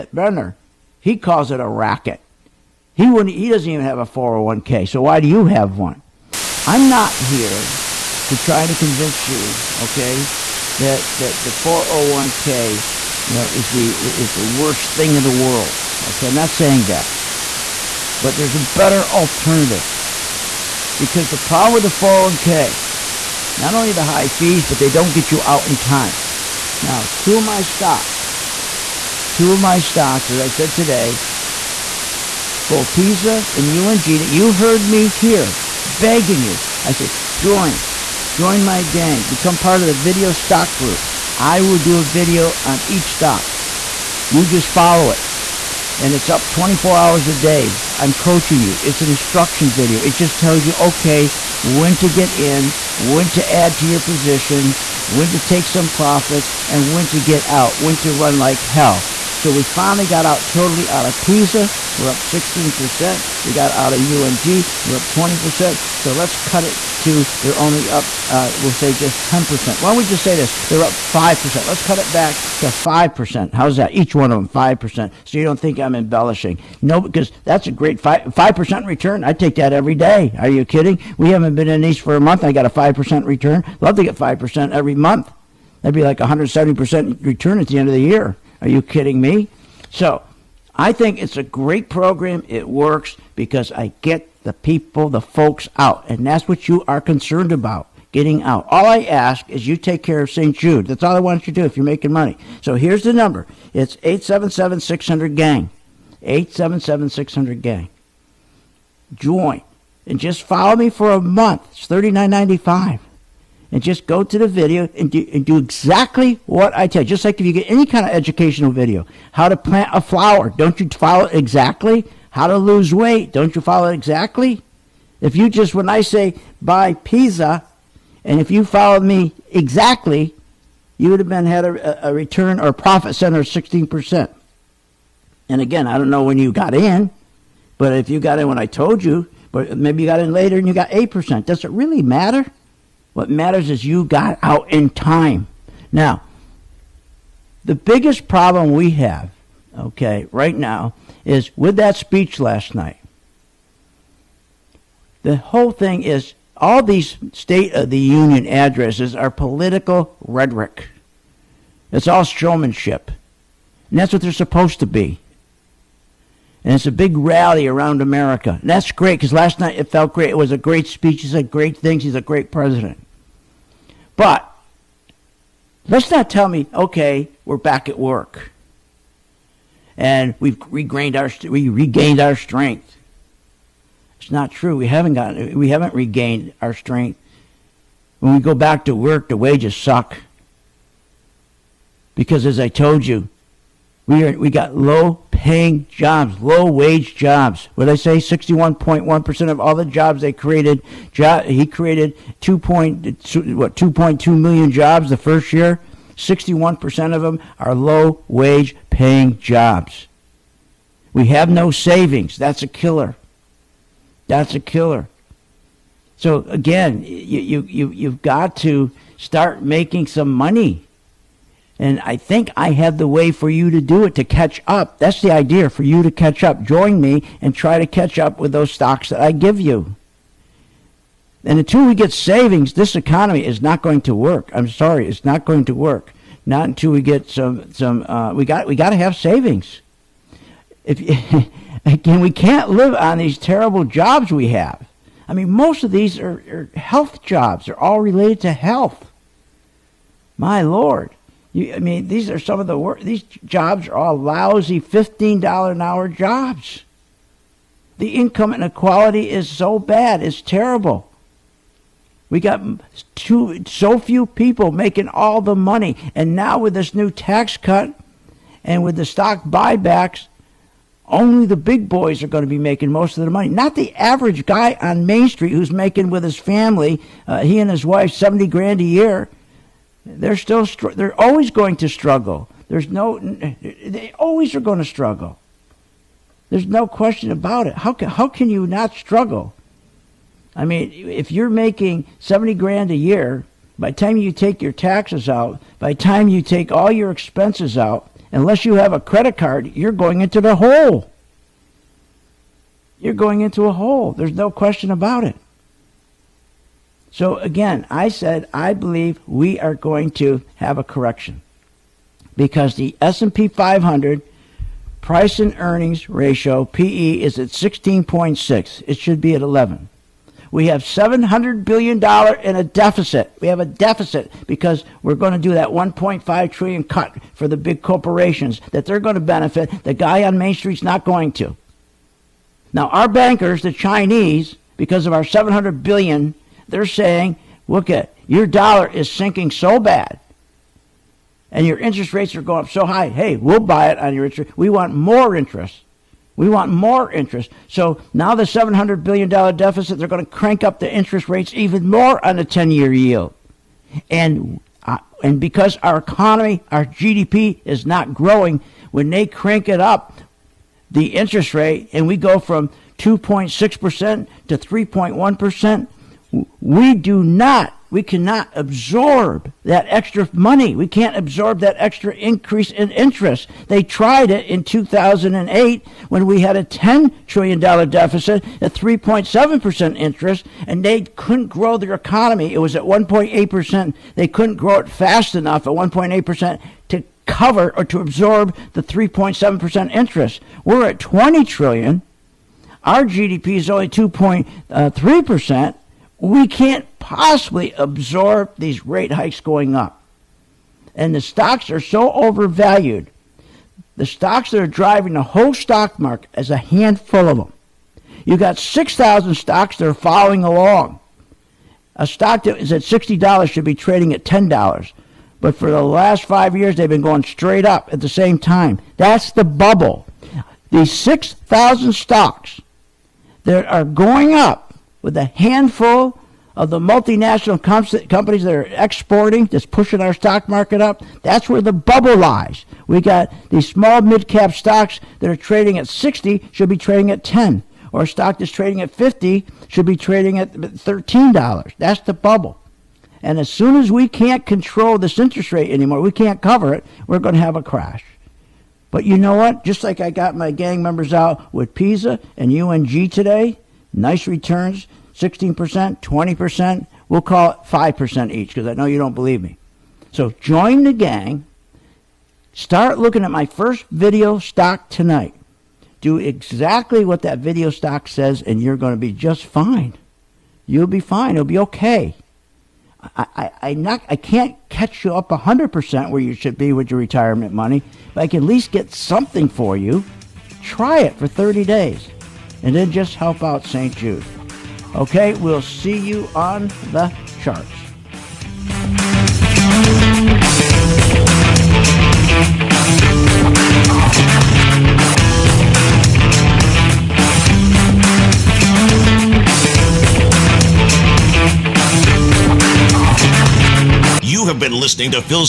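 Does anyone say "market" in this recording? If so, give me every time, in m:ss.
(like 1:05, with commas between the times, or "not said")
6:45, 7:10.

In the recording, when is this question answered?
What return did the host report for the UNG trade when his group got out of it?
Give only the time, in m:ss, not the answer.
1:04.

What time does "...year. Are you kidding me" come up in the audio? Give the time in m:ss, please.
1:28.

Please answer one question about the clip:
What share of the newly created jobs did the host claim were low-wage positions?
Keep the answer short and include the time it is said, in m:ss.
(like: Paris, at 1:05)
61.1%, at 3:18.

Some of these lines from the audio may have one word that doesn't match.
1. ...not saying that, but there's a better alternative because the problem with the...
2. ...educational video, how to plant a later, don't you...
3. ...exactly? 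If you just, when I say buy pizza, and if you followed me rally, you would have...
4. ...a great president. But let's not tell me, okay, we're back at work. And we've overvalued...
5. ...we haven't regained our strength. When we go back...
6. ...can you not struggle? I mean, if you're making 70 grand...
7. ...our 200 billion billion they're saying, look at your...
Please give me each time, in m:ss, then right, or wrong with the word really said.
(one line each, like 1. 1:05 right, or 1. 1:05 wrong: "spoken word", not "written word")
1. 0:16 right
2. 1:58 wrong: "flower", not "later"
3. 2:03 wrong: "exactly", not "rally"
4. 2:52 wrong: "regained", not "overvalued"
5. 3:05 right
6. 4:48 right
7. 5:35 wrong: "700", not "200".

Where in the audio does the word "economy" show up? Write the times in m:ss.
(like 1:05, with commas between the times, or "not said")
3:52, 5:55, 6:21.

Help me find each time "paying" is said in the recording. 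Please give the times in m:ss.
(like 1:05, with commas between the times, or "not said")
3:15, 3:28.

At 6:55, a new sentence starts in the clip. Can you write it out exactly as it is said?
But for the last five years, they've been going straight up at the same time.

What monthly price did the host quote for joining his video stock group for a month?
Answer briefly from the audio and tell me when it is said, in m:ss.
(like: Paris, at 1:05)
39, at 1:51.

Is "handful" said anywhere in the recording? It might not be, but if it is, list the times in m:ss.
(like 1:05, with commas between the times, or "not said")
6:46, 7:05.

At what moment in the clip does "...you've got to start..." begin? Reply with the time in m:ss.
3:37.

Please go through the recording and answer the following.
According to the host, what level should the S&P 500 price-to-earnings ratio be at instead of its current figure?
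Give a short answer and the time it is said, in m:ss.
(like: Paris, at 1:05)
11, at 5:18.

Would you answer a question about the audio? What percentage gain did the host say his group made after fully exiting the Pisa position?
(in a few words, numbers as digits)
16%.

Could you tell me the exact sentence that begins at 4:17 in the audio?
The income inequality is so bad, it's terrible.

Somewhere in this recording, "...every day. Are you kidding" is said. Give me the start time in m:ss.
1:19.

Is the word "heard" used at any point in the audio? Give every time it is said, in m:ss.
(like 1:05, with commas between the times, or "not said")
0:34.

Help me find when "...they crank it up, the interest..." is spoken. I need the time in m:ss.
5:59.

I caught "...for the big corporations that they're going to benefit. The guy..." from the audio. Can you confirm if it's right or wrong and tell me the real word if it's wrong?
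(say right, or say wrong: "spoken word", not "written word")
right.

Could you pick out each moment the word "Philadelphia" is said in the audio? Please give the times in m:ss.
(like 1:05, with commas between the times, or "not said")
not said.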